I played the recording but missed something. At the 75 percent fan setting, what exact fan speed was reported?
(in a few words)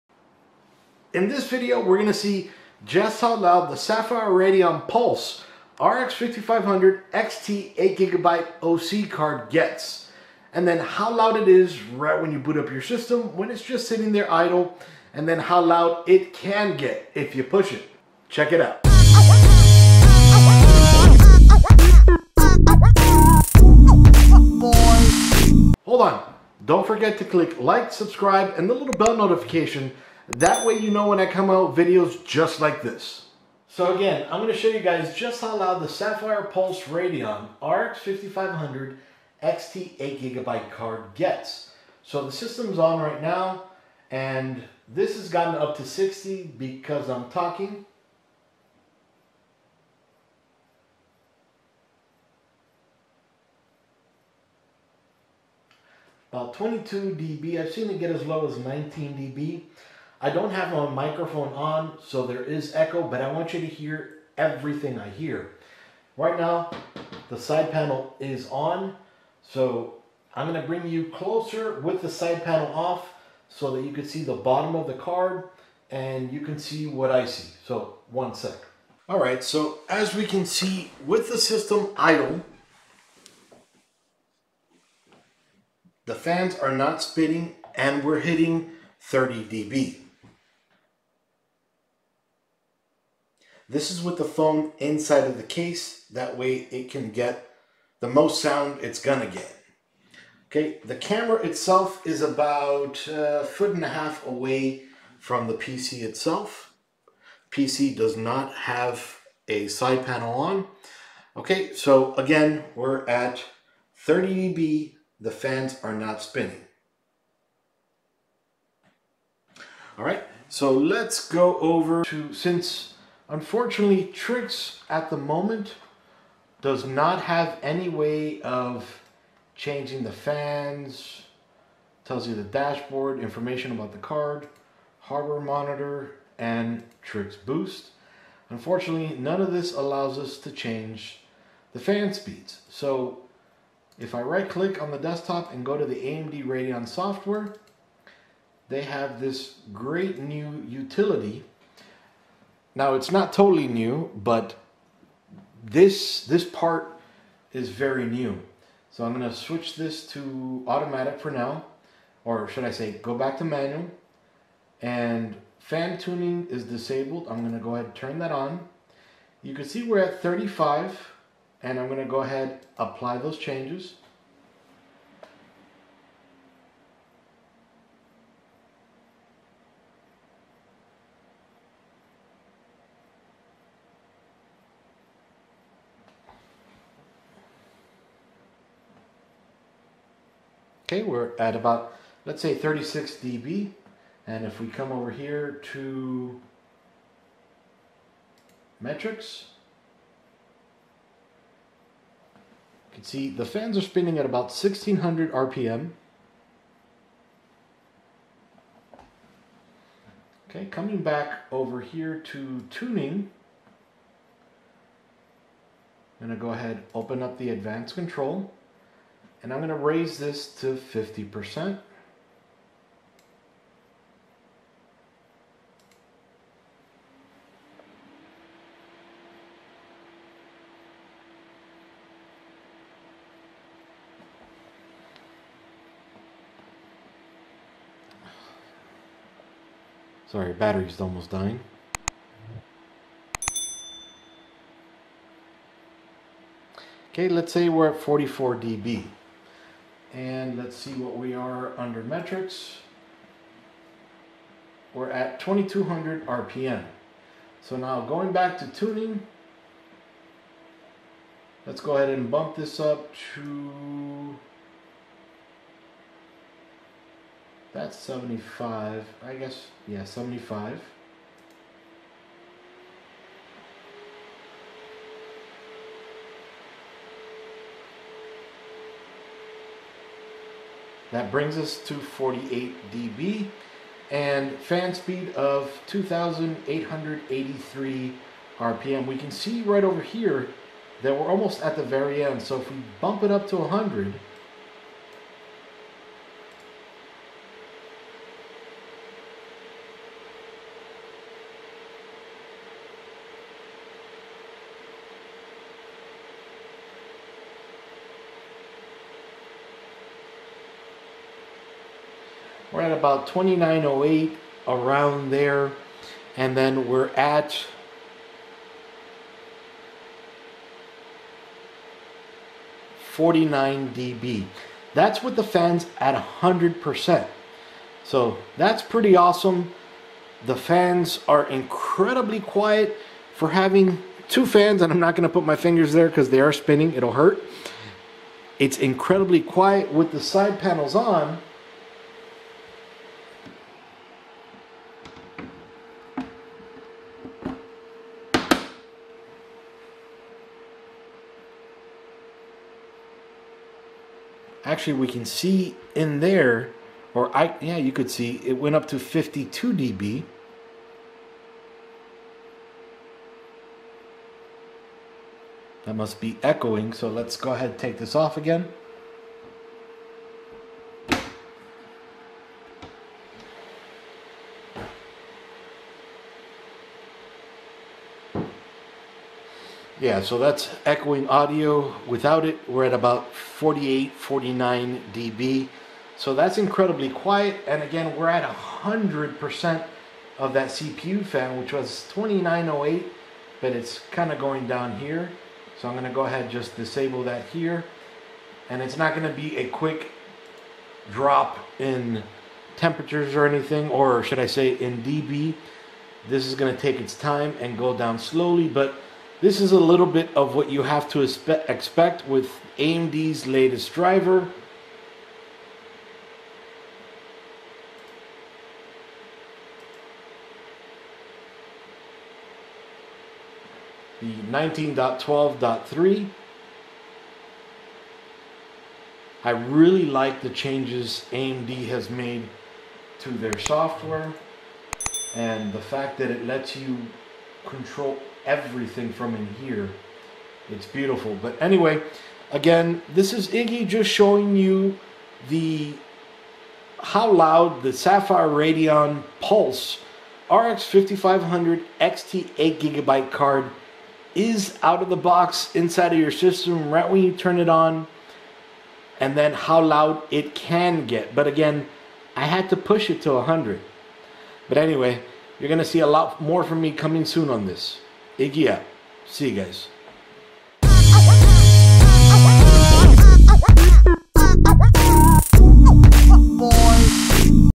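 2883 RPM.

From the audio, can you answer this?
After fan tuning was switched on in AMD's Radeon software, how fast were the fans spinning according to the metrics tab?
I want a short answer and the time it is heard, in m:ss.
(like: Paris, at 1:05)
1600 RPM, at 3:24.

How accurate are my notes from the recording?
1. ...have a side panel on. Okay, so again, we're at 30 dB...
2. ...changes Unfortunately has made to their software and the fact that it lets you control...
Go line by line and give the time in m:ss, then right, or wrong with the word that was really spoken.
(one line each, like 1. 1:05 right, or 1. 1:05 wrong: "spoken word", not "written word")
1. 1:48 right
2. 7:10 wrong: "AMD", not "Unfortunately".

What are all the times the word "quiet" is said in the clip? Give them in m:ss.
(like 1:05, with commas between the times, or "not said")
5:32, 5:39, 6:27.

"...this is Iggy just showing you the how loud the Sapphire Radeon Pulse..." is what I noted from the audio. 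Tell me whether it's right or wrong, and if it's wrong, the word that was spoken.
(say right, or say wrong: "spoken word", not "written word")
right.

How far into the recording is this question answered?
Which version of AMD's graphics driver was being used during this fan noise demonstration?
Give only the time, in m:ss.
7:04.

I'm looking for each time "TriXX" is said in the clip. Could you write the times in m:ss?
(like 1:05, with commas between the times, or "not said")
2:04, 2:17.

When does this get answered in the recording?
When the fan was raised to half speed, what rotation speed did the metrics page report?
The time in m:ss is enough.
4:15.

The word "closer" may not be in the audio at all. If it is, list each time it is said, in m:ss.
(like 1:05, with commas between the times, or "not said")
1:11.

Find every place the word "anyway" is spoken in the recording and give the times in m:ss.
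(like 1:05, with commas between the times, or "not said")
7:21, 7:44.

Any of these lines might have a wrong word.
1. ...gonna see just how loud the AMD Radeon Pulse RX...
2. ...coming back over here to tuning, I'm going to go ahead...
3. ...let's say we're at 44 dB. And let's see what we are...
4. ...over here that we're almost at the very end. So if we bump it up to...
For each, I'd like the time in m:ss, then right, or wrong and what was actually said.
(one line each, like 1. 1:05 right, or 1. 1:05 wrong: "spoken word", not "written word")
1. 0:01 wrong: "Sapphire", not "AMD"
2. 3:30 right
3. 4:07 right
4. 4:49 right.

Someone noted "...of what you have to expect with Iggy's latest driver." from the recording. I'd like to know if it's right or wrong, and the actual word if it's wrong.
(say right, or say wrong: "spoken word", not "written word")
wrong: "AMD", not "Iggy".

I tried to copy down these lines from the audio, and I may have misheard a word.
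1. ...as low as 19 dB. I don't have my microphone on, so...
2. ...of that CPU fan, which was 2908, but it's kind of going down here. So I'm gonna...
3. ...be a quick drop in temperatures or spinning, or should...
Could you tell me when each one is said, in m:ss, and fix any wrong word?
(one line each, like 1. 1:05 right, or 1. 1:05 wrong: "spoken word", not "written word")
1. 0:58 right
2. 6:30 right
3. 6:39 wrong: "anything", not "spinning".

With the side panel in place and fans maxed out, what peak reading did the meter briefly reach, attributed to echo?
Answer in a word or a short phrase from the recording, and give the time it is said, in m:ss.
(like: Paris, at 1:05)
52 dB, at 5:58.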